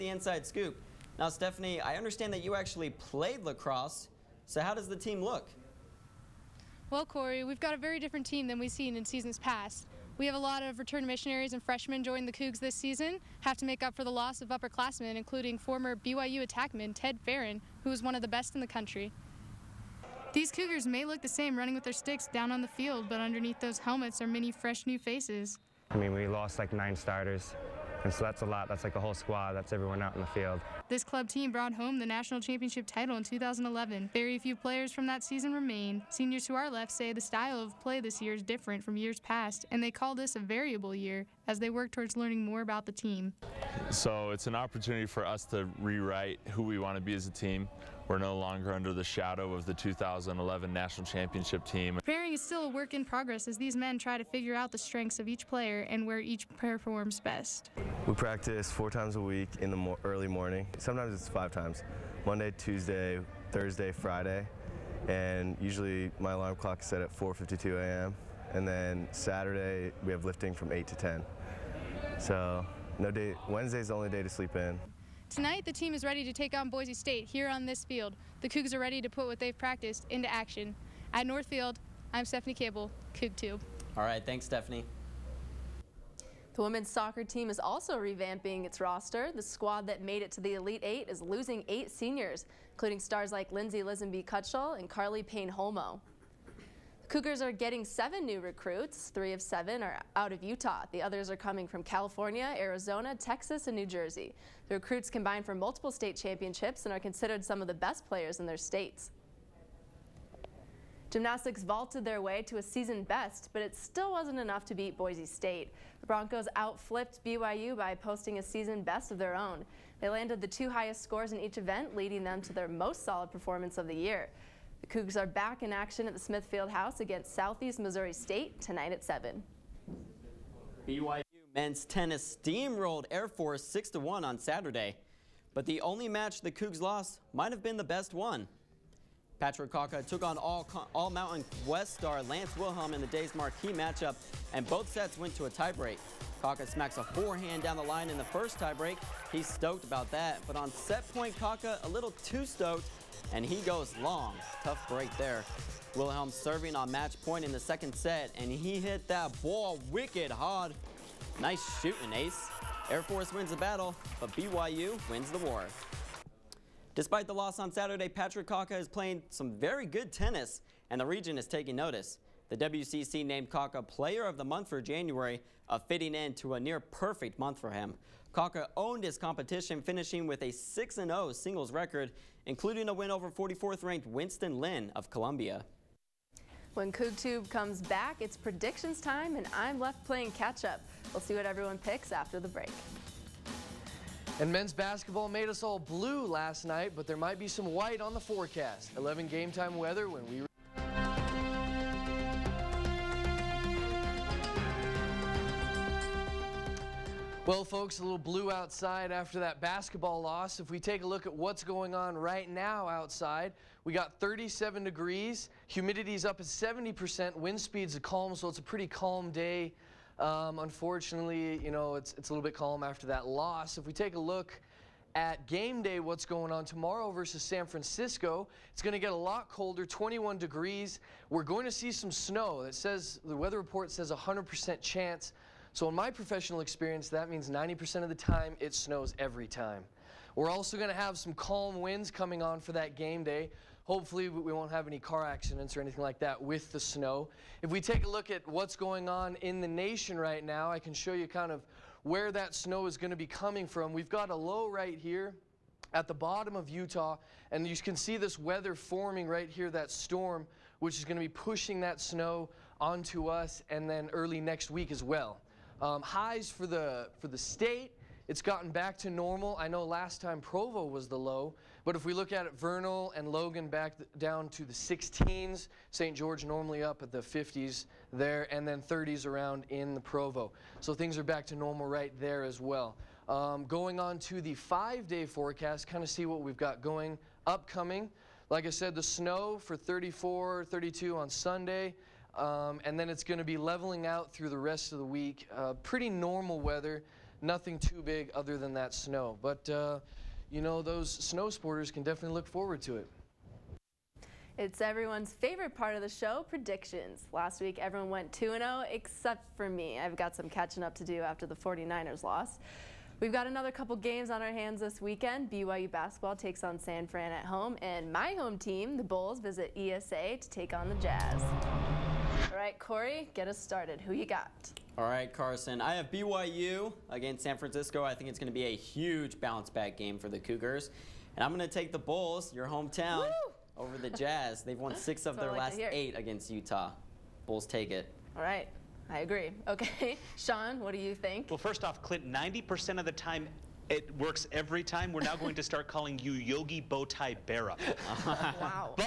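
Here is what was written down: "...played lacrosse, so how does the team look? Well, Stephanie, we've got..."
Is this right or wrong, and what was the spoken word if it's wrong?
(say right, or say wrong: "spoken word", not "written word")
wrong: "Corey", not "Stephanie".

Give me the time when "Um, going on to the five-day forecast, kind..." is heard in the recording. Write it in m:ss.
4:43.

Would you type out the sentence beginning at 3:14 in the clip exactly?
And men's basketball made us all blue last night, but there might be some white on the forecast.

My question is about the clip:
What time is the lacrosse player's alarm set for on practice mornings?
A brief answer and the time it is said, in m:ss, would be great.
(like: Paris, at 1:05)
4:52 a.m., at 1:07.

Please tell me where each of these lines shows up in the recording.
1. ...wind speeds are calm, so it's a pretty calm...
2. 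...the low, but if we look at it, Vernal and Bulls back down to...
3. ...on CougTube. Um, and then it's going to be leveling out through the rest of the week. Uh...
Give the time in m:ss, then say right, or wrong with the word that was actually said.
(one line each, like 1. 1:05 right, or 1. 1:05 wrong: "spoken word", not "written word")
1. 3:37 right
2. 4:31 wrong: "Logan", not "Bulls"
3. 4:51 wrong: "Sunday", not "CougTube".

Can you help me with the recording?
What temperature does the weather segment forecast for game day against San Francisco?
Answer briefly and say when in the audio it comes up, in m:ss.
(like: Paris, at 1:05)
21 degrees, at 3:49.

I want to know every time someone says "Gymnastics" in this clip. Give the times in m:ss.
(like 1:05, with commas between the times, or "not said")
1:51.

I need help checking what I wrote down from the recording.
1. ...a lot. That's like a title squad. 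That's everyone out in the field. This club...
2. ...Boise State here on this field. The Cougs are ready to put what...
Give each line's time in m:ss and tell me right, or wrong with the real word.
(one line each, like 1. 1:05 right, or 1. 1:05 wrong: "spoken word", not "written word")
1. 0:28 wrong: "whole", not "title"
2. 1:16 right.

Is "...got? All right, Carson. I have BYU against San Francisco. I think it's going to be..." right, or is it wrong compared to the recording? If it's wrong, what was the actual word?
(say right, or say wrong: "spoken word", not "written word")
right.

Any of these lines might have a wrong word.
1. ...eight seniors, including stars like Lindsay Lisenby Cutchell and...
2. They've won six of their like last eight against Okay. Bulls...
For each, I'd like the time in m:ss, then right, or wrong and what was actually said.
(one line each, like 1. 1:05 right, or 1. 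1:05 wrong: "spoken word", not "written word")
1. 1:31 right
2. 5:34 wrong: "Utah", not "Okay".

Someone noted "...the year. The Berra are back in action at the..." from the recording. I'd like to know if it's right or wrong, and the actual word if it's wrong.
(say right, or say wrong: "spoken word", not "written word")
wrong: "Cougs", not "Berra".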